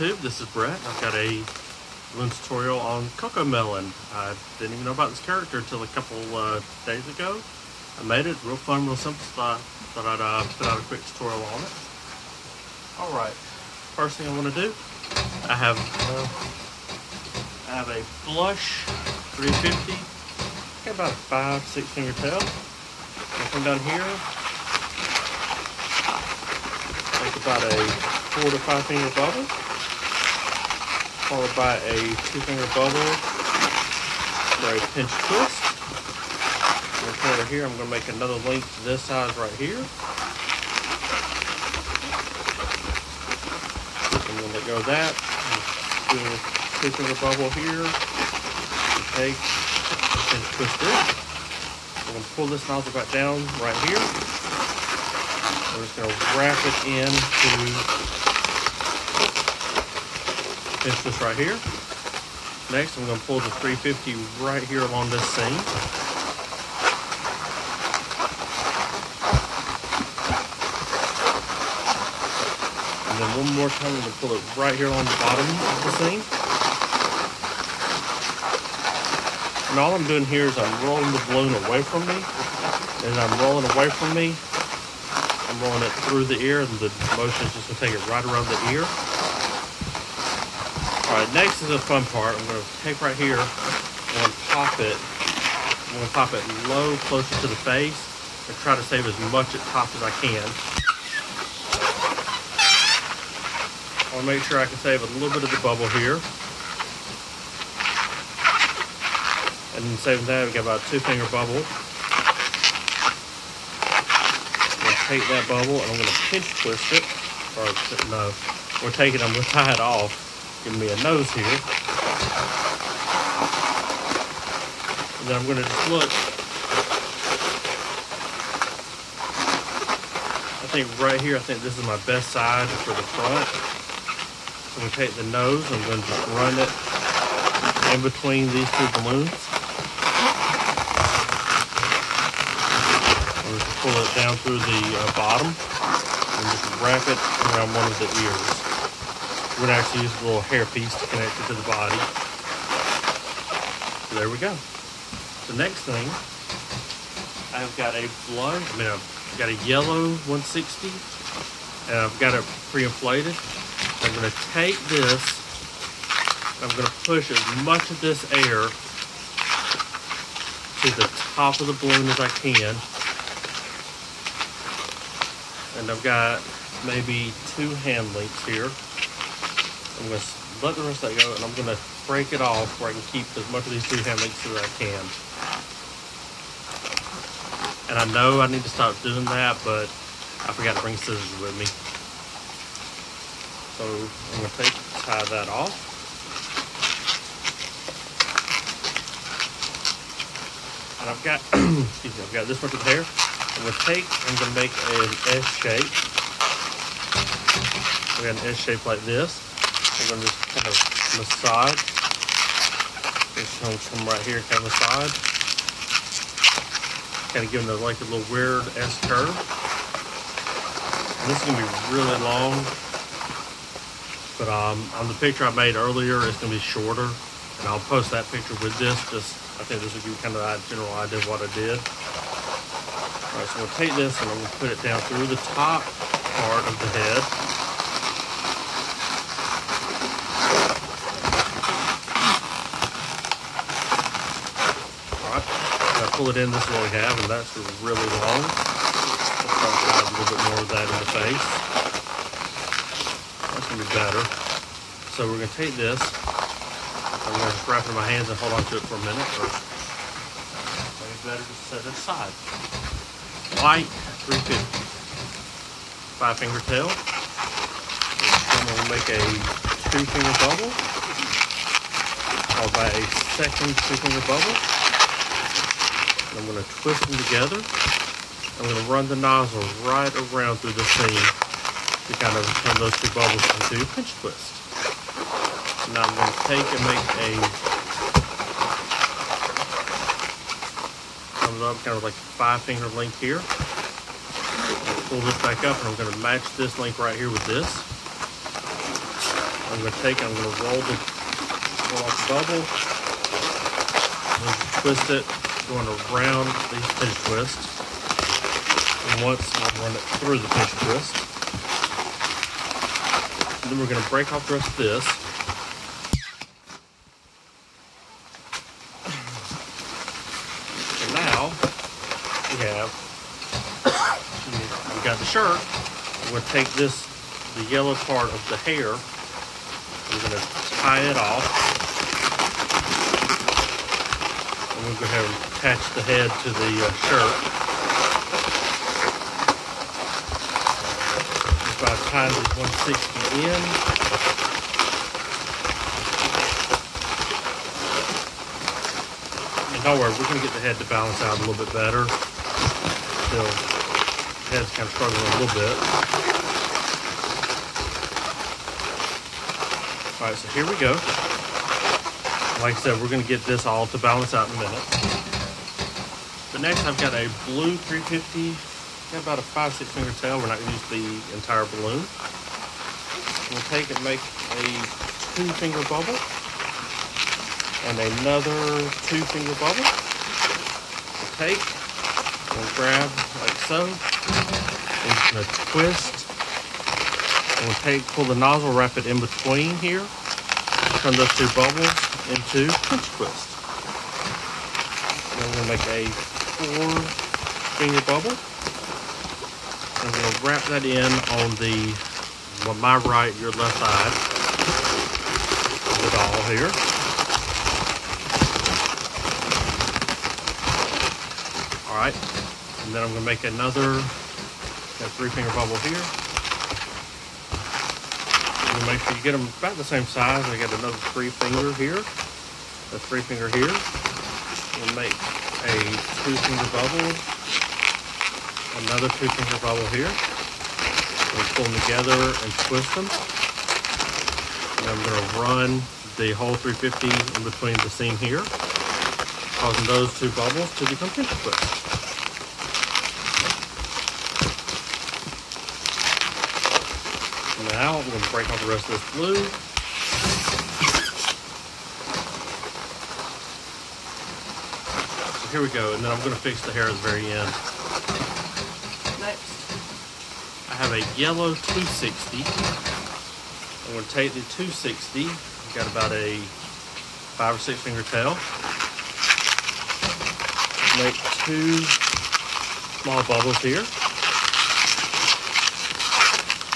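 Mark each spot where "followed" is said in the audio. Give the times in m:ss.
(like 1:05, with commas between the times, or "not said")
0:31, 4:32.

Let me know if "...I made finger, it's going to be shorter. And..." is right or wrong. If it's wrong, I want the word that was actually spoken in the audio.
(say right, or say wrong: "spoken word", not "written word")
wrong: "earlier", not "finger".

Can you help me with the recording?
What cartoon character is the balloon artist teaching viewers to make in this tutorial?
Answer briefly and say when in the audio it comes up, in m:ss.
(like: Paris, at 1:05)
CoComelon, at 0:03.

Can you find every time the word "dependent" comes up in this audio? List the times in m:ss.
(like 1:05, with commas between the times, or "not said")
not said.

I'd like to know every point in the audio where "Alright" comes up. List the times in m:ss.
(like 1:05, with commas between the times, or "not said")
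0:12, 3:53, 4:05.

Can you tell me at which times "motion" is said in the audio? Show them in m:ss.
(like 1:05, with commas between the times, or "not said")
1:27.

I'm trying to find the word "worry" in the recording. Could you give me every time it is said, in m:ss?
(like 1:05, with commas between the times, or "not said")
5:49.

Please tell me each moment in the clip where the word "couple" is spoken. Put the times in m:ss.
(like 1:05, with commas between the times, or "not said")
0:05.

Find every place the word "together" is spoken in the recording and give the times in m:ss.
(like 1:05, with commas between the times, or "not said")
4:37, 7:11.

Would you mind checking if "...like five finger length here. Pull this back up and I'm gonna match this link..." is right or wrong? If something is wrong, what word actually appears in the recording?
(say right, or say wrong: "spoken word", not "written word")
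right.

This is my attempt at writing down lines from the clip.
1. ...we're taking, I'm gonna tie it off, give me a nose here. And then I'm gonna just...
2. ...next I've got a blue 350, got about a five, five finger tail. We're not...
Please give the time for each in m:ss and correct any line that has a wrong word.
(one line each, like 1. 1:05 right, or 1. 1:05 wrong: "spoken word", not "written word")
1. 1:58 right
2. 6:06 wrong: "six", not "five".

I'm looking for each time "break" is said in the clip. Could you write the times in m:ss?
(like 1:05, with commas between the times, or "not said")
3:02, 5:14, 7:28.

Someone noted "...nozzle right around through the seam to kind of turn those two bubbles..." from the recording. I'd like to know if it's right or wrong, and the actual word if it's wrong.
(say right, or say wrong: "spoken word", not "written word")
right.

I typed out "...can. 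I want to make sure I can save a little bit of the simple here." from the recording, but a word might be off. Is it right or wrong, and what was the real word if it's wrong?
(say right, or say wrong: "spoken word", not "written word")
wrong: "bubble", not "simple".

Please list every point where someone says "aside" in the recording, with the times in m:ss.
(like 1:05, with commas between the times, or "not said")
4:21.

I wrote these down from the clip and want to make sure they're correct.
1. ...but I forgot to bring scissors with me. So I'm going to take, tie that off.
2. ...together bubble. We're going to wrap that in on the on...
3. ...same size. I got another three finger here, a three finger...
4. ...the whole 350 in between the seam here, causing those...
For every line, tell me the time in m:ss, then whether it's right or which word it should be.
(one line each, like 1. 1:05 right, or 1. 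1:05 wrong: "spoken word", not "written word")
1. 3:09 right
2. 6:37 wrong: "finger", not "together"
3. 6:59 right
4. 7:16 right.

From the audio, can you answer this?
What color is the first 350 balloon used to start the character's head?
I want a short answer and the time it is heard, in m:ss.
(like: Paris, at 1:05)
blush, at 0:18.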